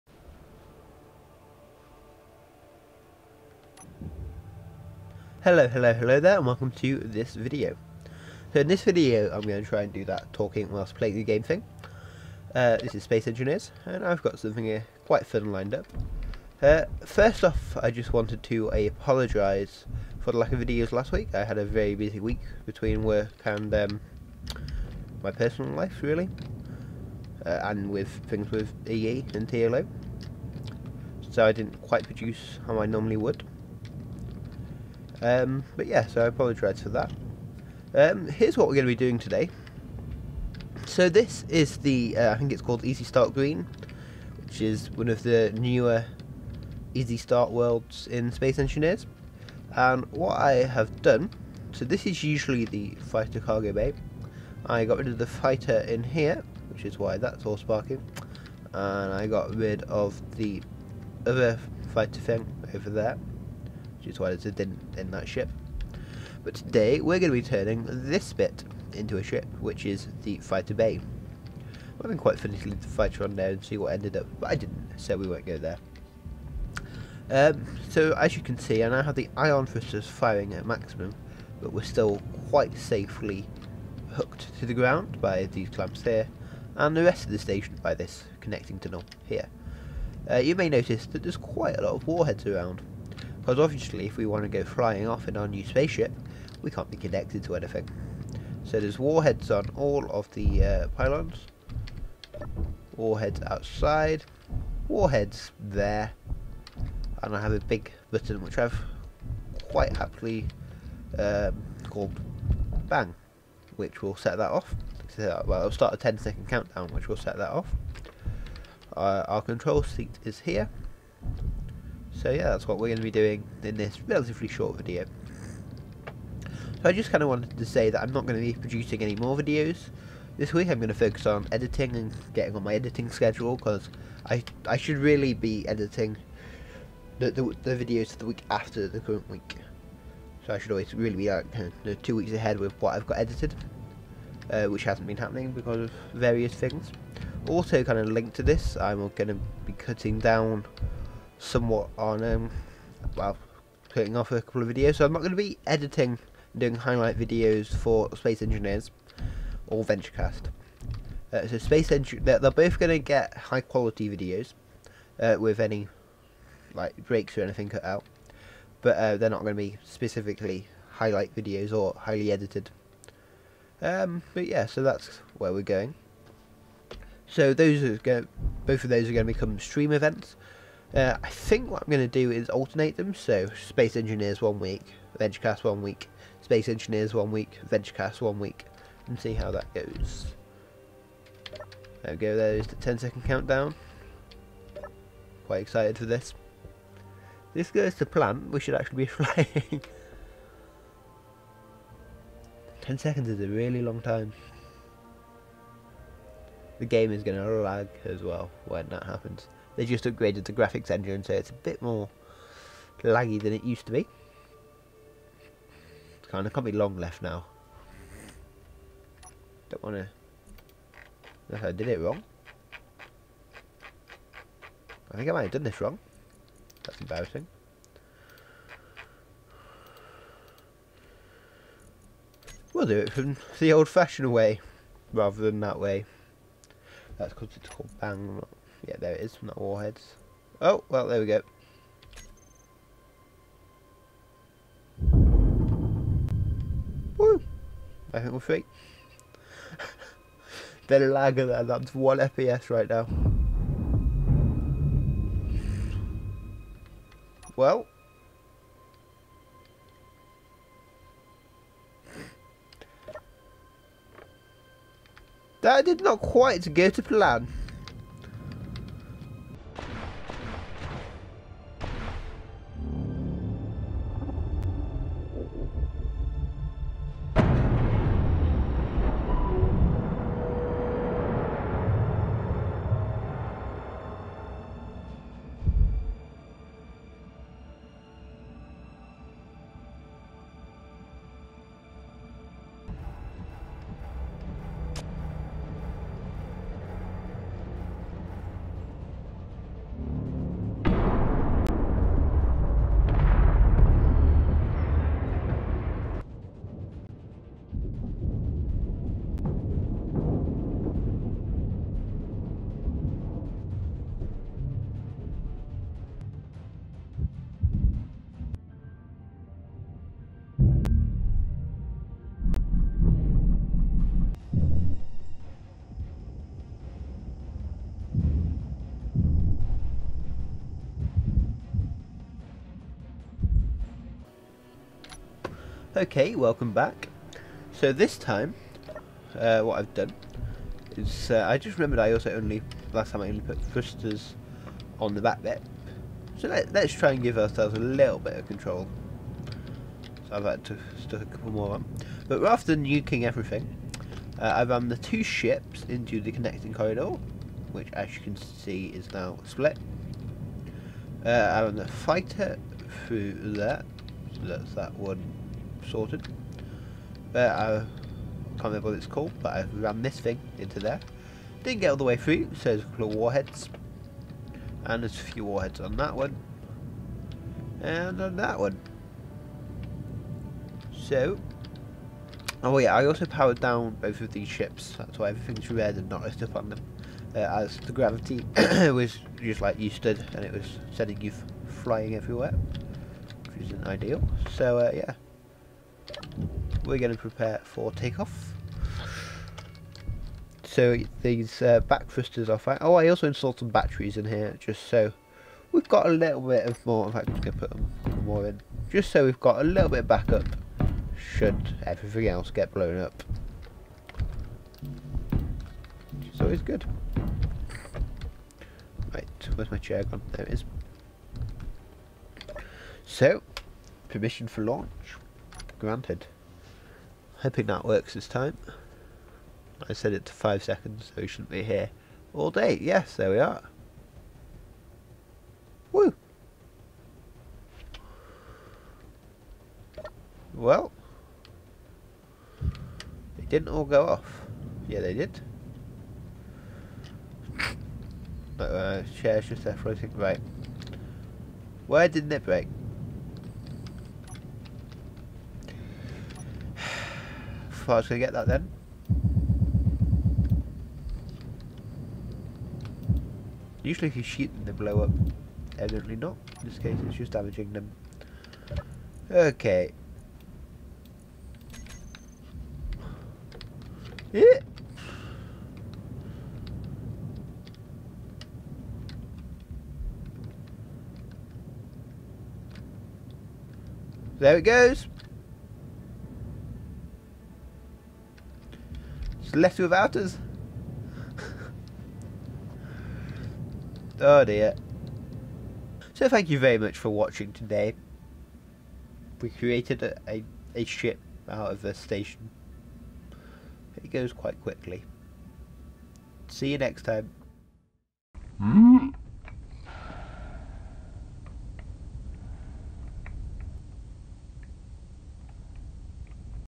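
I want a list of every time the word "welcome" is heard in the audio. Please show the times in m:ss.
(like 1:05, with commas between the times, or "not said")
0:06, 5:36.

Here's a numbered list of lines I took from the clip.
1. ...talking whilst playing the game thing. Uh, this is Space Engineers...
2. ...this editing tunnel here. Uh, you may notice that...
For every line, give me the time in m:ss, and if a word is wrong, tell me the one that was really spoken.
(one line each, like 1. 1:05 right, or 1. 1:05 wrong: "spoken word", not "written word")
1. 0:10 right
2. 1:27 wrong: "connecting", not "editing".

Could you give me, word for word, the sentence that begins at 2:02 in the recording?
So yeah, that's what we're going to be doing in this relatively short video.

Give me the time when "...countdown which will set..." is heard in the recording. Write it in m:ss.
1:56.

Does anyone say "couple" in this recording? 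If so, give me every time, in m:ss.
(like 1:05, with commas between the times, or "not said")
2:34, 5:51, 6:12.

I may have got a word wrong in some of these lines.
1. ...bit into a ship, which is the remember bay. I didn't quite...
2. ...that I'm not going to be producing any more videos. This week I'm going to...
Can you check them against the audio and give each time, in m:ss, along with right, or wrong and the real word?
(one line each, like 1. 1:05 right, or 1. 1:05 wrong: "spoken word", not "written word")
1. 1:08 wrong: "fighter", not "remember"
2. 2:07 right.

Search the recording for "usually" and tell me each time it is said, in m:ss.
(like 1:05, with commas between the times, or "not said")
0:52, 7:43.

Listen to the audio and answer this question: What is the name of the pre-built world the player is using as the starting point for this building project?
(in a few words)
Easy Start Green.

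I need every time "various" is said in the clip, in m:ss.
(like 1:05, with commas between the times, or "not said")
2:26.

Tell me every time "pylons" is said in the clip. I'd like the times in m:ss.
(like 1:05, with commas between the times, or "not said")
1:40.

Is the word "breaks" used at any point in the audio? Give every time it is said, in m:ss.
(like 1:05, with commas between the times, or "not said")
2:47, 7:32.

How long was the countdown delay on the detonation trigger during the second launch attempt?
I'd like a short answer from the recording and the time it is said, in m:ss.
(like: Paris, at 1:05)
5 seconds, at 7:10.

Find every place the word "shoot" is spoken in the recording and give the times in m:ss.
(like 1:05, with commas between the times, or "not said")
7:44.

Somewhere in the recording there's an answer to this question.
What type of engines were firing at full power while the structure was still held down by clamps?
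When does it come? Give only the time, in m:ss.
1:19.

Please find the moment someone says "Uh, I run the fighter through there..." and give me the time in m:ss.
6:01.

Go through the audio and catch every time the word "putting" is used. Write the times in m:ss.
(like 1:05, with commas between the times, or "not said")
2:33.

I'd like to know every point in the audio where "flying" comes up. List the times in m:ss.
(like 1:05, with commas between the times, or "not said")
1:34, 3:19, 6:31.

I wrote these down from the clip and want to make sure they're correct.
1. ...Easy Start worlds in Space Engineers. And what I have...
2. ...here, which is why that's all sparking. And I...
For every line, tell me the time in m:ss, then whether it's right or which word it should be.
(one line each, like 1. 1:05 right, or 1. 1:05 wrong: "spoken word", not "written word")
1. 0:46 right
2. 0:56 right.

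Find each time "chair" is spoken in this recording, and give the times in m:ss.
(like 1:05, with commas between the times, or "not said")
6:59, 7:29.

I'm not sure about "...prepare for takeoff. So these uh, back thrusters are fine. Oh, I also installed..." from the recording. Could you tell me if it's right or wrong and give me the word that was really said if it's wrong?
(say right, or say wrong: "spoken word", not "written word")
right.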